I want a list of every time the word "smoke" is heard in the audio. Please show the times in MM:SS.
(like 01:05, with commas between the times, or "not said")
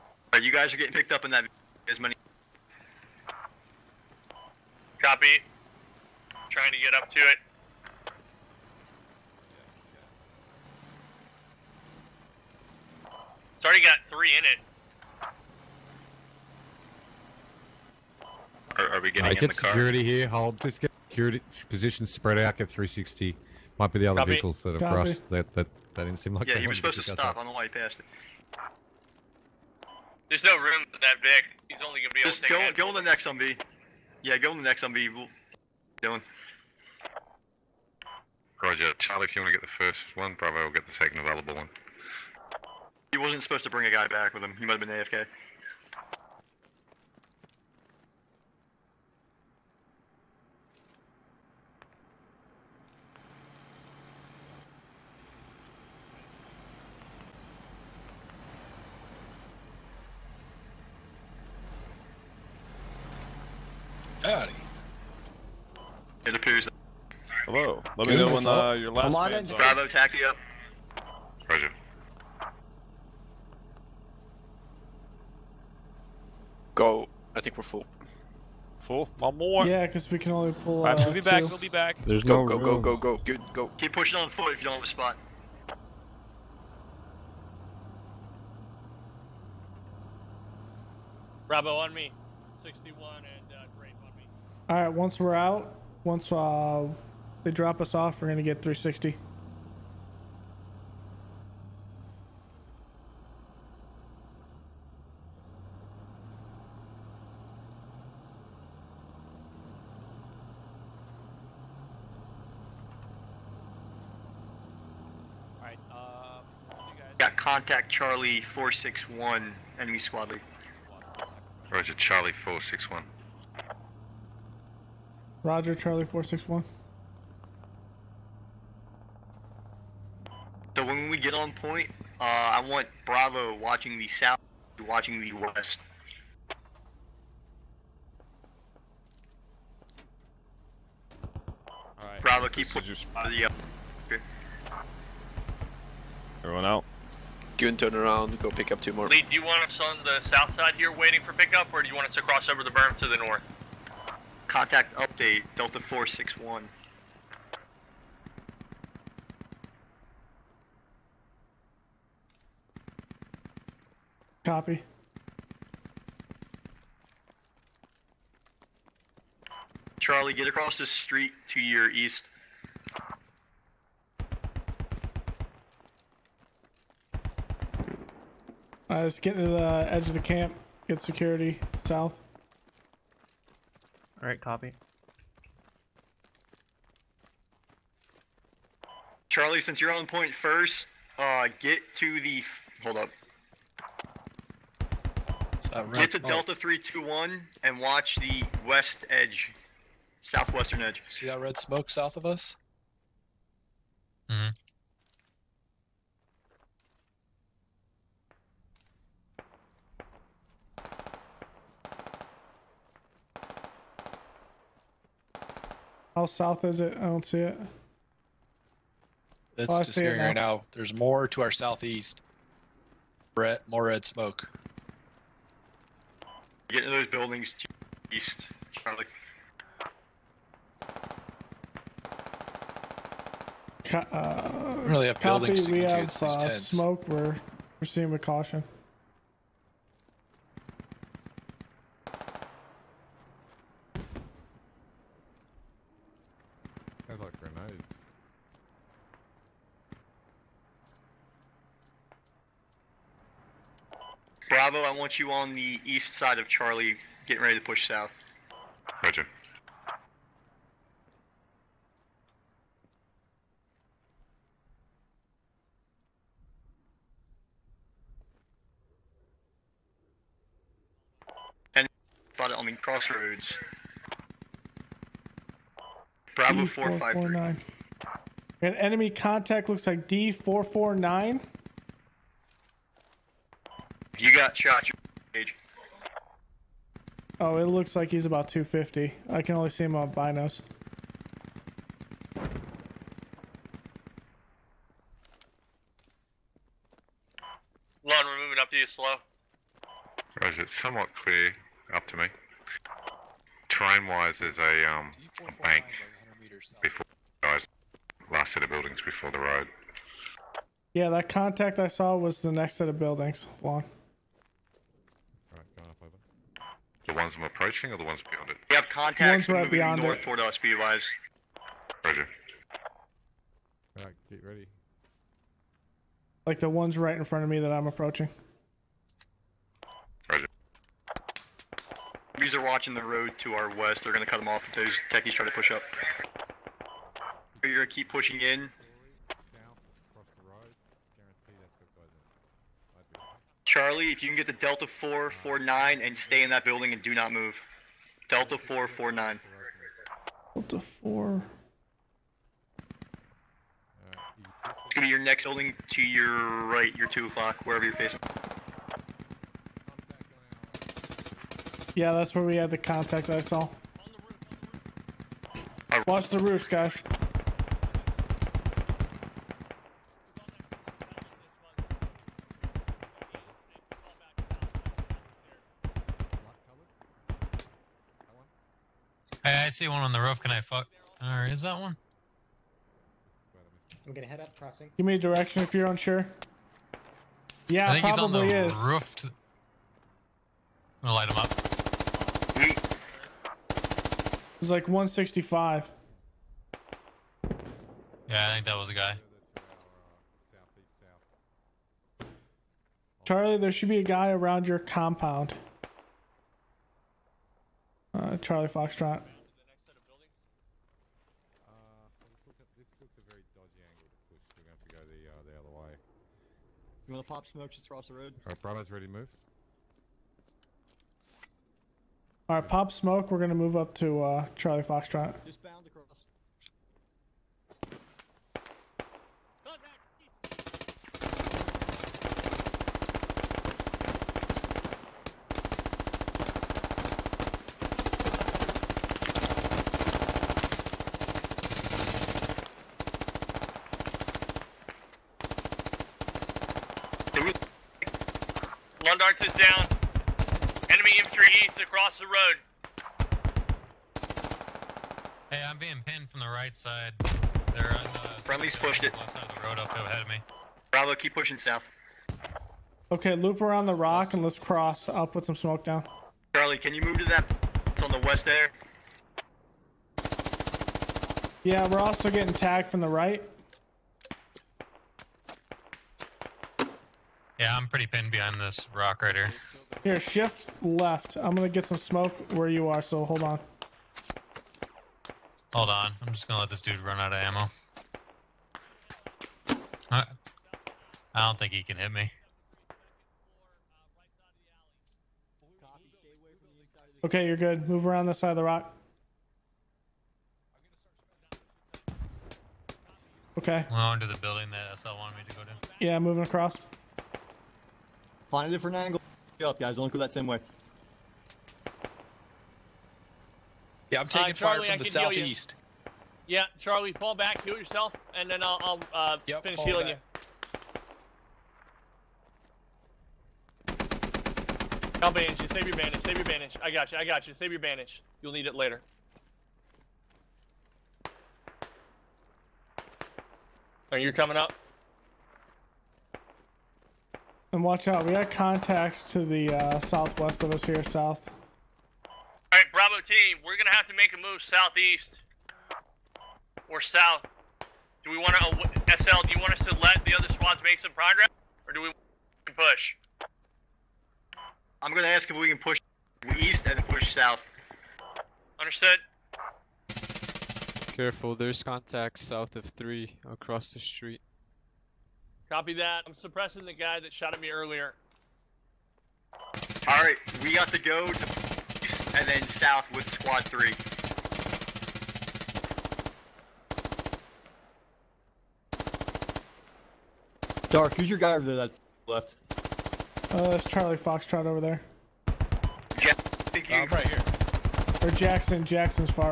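03:21, 03:44, 03:56, 06:57, 07:02, 07:45, 08:01.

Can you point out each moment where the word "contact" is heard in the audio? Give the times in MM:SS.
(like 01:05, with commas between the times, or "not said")
01:57, 02:34, 04:39, 05:11, 05:18, 06:02, 08:58, 09:21.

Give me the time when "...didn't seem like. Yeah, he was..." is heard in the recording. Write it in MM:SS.
00:26.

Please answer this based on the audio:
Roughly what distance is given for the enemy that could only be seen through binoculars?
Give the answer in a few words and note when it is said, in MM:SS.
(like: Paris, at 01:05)
250, at 04:48.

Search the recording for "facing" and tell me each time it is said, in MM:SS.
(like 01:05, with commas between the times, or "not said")
05:57.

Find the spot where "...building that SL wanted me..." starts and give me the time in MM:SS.
08:24.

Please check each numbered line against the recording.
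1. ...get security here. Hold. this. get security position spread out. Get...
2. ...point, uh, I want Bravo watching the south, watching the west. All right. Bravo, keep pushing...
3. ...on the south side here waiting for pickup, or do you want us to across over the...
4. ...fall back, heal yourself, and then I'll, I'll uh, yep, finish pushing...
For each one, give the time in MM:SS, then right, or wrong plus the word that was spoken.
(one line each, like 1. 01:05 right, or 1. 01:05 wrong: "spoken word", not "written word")
1. 00:19 right
2. 02:11 right
3. 02:29 wrong: "cross", not "across"
4. 08:37 wrong: "healing", not "pushing".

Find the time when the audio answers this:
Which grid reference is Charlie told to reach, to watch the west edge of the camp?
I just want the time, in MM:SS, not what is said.
03:16.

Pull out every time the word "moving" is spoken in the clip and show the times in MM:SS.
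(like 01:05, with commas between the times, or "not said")
04:58, 08:26.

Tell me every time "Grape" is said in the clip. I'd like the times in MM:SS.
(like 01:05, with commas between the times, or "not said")
01:33.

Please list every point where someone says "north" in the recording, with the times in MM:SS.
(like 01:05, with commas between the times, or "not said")
02:33, 05:20.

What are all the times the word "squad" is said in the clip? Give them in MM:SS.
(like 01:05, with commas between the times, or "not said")
01:59, 09:10, 09:33.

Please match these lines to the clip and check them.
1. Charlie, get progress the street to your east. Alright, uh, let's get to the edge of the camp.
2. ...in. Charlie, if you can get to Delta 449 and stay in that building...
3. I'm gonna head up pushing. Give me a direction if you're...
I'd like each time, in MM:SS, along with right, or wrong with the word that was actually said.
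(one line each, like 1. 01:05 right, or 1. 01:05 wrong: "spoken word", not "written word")
1. 02:49 wrong: "across", not "progress"
2. 05:38 right
3. 06:24 wrong: "crossing", not "pushing".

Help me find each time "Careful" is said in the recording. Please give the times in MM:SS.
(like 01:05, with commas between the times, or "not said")
09:21.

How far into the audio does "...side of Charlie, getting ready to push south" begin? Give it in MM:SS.
04:16.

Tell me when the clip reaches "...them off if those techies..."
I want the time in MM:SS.
05:34.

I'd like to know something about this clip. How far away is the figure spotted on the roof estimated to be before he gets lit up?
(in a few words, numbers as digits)
165.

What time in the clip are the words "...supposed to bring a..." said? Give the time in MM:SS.
00:43.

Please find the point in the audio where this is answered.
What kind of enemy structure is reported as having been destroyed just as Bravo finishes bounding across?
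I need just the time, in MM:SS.
07:29.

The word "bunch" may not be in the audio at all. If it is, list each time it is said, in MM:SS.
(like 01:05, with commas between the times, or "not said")
not said.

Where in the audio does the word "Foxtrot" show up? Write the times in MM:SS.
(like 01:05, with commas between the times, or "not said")
06:48, 07:04, 09:44.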